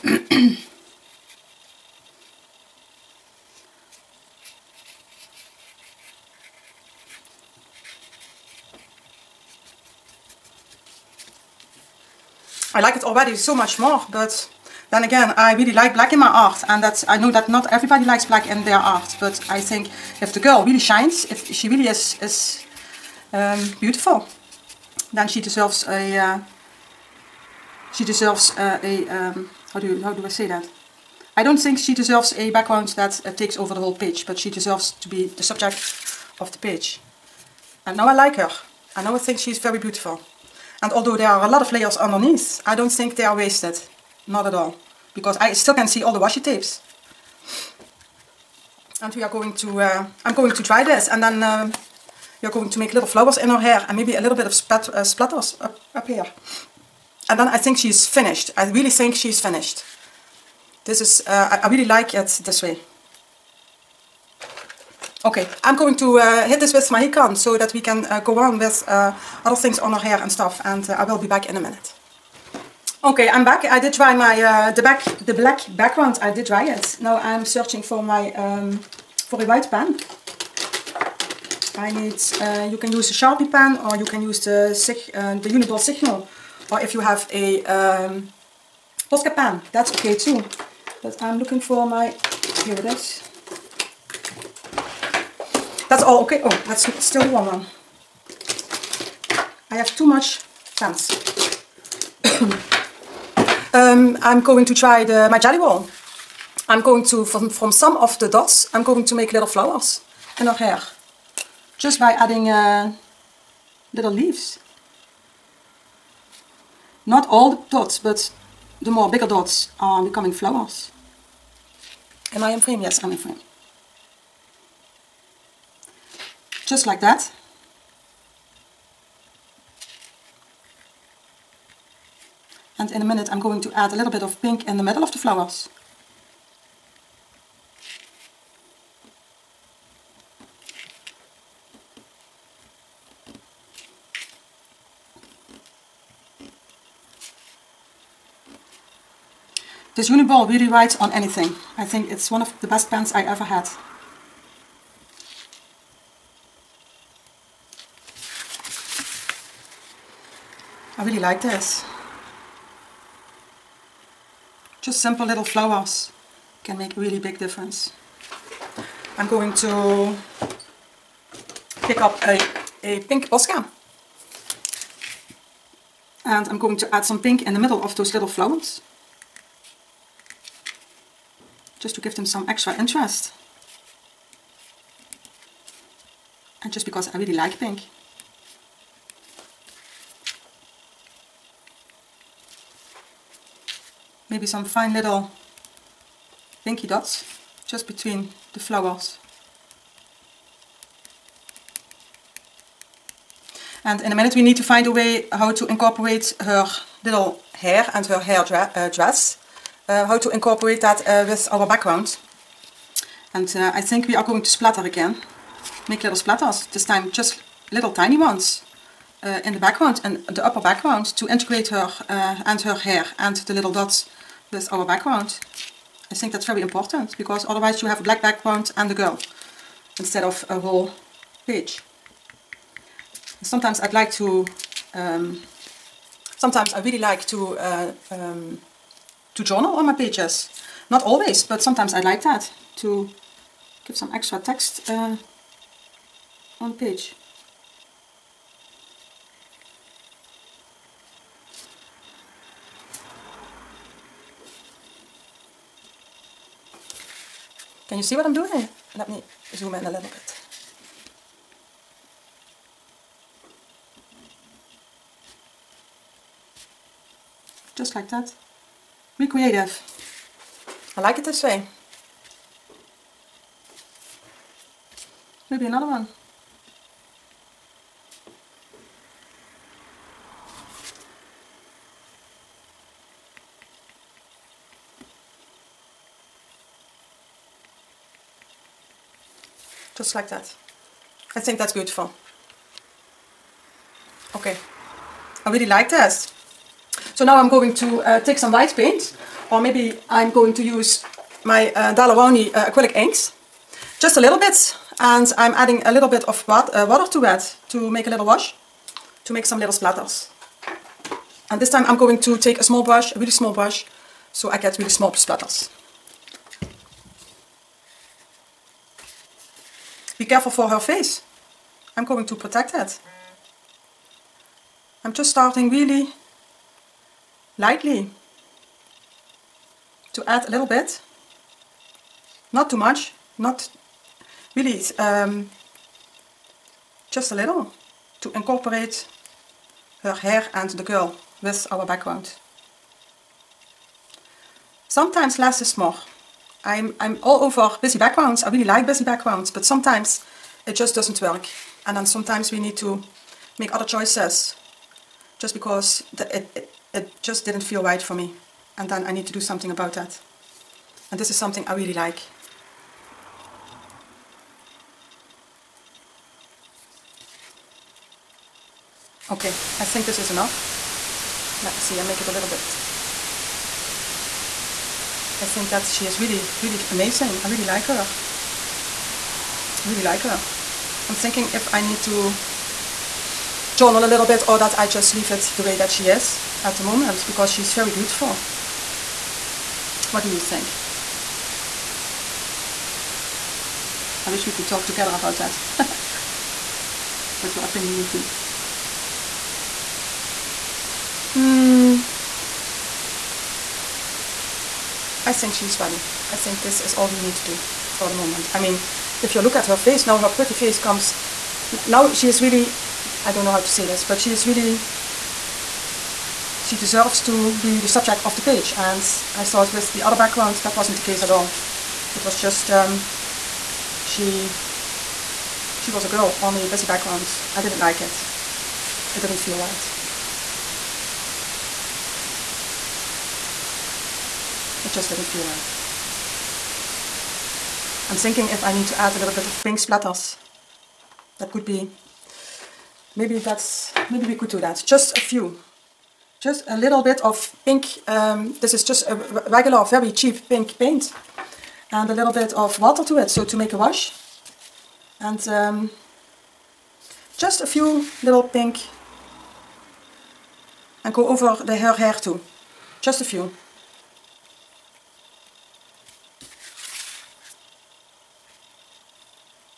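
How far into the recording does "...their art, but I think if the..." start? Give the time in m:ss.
0:18.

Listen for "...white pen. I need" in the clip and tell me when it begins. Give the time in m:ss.
1:19.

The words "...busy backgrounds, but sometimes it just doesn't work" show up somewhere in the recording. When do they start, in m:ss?
5:48.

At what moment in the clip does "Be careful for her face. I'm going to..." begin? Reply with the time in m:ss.
5:20.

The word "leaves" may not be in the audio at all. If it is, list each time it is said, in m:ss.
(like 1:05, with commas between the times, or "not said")
1:54, 6:25.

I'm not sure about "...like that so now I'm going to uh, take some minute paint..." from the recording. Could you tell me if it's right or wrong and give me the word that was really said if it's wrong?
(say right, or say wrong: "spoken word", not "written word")
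wrong: "white", not "minute".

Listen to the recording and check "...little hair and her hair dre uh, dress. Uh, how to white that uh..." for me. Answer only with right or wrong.
wrong.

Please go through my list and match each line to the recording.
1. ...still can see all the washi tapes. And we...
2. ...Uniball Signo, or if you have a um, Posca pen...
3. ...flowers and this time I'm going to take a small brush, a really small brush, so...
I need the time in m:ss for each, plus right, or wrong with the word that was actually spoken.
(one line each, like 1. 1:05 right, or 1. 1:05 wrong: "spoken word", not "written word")
1. 0:45 right
2. 1:25 right
3. 5:09 wrong: "splatters", not "flowers".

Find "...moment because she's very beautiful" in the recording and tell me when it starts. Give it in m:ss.
6:26.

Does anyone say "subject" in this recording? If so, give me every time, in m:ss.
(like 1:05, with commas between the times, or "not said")
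0:35, 6:57.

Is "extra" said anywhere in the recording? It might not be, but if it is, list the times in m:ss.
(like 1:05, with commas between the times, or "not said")
3:02, 4:04.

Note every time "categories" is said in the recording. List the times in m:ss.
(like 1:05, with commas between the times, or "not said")
not said.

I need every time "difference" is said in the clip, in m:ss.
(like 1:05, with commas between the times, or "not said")
2:47.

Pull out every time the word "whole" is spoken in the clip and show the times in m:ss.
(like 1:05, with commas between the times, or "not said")
0:33, 3:50.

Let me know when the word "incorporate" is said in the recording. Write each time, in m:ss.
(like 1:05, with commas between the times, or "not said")
3:25, 3:30, 5:38.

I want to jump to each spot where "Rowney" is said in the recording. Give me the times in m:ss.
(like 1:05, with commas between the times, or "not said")
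5:01.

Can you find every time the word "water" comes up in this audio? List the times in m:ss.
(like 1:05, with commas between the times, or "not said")
5:06, 7:32.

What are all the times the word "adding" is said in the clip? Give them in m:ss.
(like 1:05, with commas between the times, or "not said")
1:52, 5:05.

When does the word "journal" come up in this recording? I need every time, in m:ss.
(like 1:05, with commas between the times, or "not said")
3:59, 6:23.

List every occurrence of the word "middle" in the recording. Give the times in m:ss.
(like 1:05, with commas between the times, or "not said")
2:14, 2:57.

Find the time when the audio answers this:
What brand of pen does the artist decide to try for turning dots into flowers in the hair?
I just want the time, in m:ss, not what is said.
1:45.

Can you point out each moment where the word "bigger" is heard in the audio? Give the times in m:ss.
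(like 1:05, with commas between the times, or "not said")
1:59.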